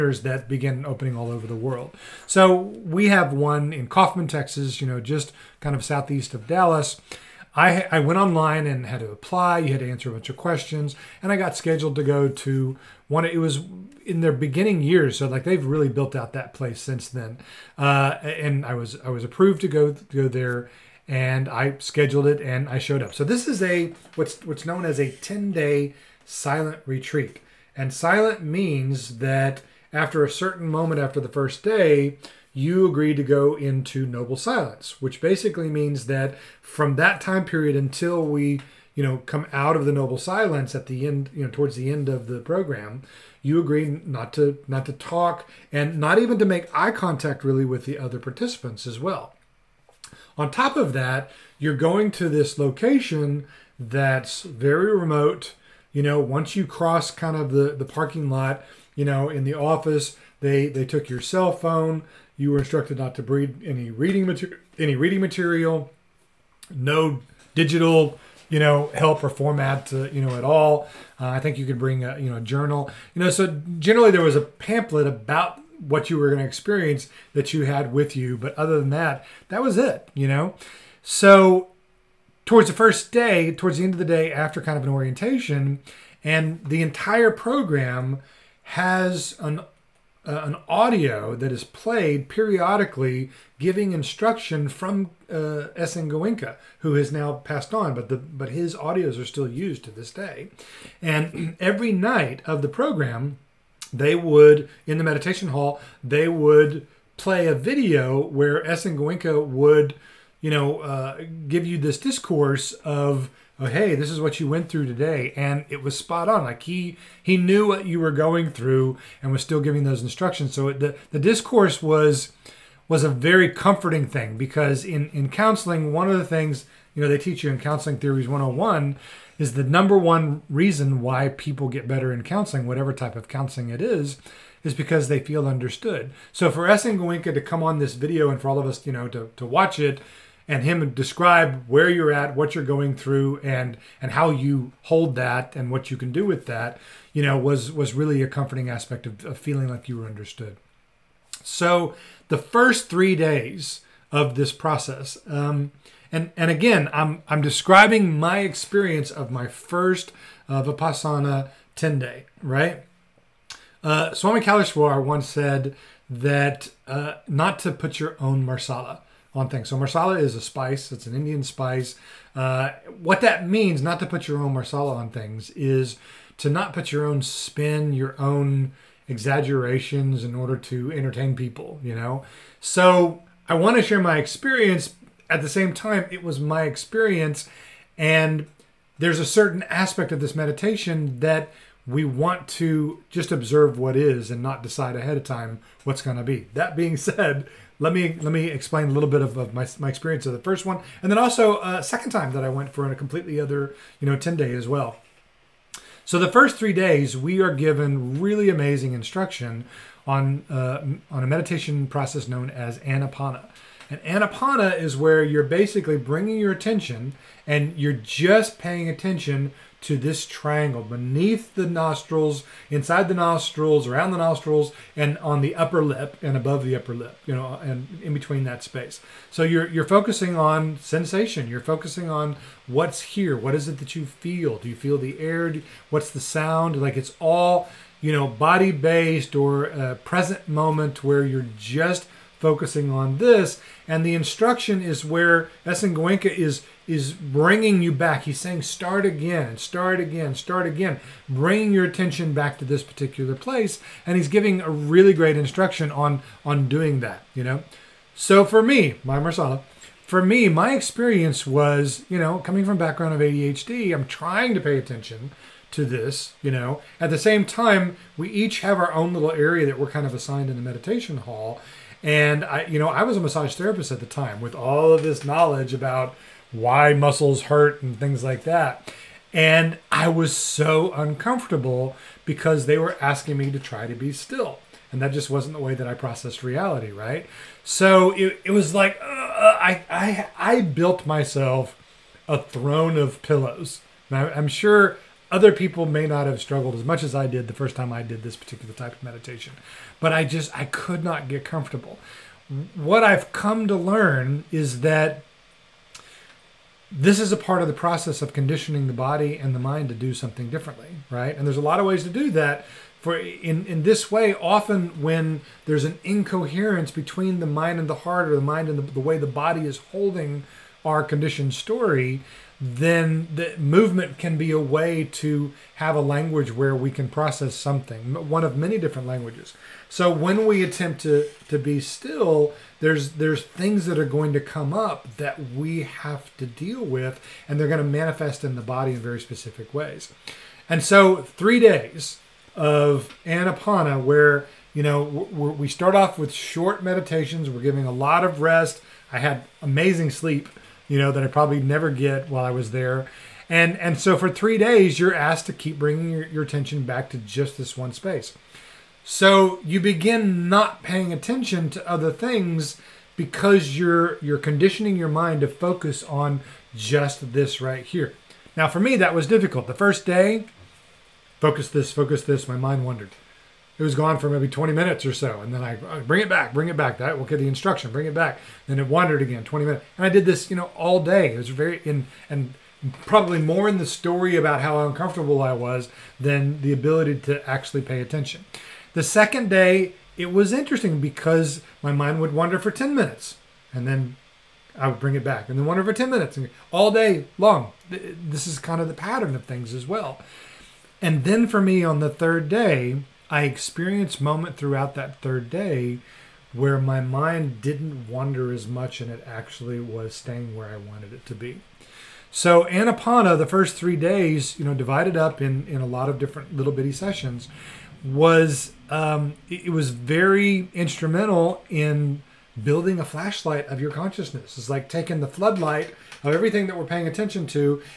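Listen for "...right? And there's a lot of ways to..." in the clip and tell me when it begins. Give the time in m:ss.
5:11.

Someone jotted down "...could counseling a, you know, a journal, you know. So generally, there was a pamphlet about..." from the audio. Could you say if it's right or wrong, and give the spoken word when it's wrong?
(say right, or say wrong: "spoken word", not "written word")
wrong: "bring", not "counseling".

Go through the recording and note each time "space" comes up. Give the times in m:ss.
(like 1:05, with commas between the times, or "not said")
3:48, 5:57.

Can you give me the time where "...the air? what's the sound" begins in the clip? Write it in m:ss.
3:54.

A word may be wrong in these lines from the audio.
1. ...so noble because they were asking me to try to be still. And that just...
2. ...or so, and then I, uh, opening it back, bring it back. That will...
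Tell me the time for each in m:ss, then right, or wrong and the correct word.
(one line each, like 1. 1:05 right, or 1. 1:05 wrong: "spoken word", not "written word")
1. 4:40 wrong: "uncomfortable", not "noble"
2. 6:15 wrong: "bring", not "opening".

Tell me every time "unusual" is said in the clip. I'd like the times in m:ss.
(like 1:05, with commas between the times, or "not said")
not said.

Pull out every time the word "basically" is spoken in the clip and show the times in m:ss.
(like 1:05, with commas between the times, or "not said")
0:35, 3:35.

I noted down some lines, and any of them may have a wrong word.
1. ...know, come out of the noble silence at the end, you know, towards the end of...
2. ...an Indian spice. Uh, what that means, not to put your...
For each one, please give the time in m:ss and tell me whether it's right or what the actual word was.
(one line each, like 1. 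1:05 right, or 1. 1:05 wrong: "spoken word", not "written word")
1. 0:39 right
2. 2:51 right.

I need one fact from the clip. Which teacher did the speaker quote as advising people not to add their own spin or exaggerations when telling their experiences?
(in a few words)
Swami Kaleshwar.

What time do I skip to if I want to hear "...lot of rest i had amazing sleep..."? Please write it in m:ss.
5:47.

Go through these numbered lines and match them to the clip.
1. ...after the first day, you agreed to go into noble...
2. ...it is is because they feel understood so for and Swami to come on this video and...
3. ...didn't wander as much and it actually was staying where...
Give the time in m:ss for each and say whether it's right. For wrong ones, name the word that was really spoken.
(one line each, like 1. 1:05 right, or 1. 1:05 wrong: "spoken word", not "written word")
1. 0:30 right
2. 2:13 wrong: "Goenka", not "Swami"
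3. 6:47 right.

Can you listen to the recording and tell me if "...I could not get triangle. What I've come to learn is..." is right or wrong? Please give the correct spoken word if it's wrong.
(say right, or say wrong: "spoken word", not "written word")
wrong: "comfortable", not "triangle".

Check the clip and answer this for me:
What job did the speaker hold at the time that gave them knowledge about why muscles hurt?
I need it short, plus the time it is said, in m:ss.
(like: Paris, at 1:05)
massage therapist, at 4:33.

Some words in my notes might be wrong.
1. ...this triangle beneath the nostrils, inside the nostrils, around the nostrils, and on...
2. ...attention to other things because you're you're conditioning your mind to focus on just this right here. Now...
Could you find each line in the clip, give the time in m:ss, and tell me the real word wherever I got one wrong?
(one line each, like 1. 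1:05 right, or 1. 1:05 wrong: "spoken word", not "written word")
1. 3:39 right
2. 6:01 right.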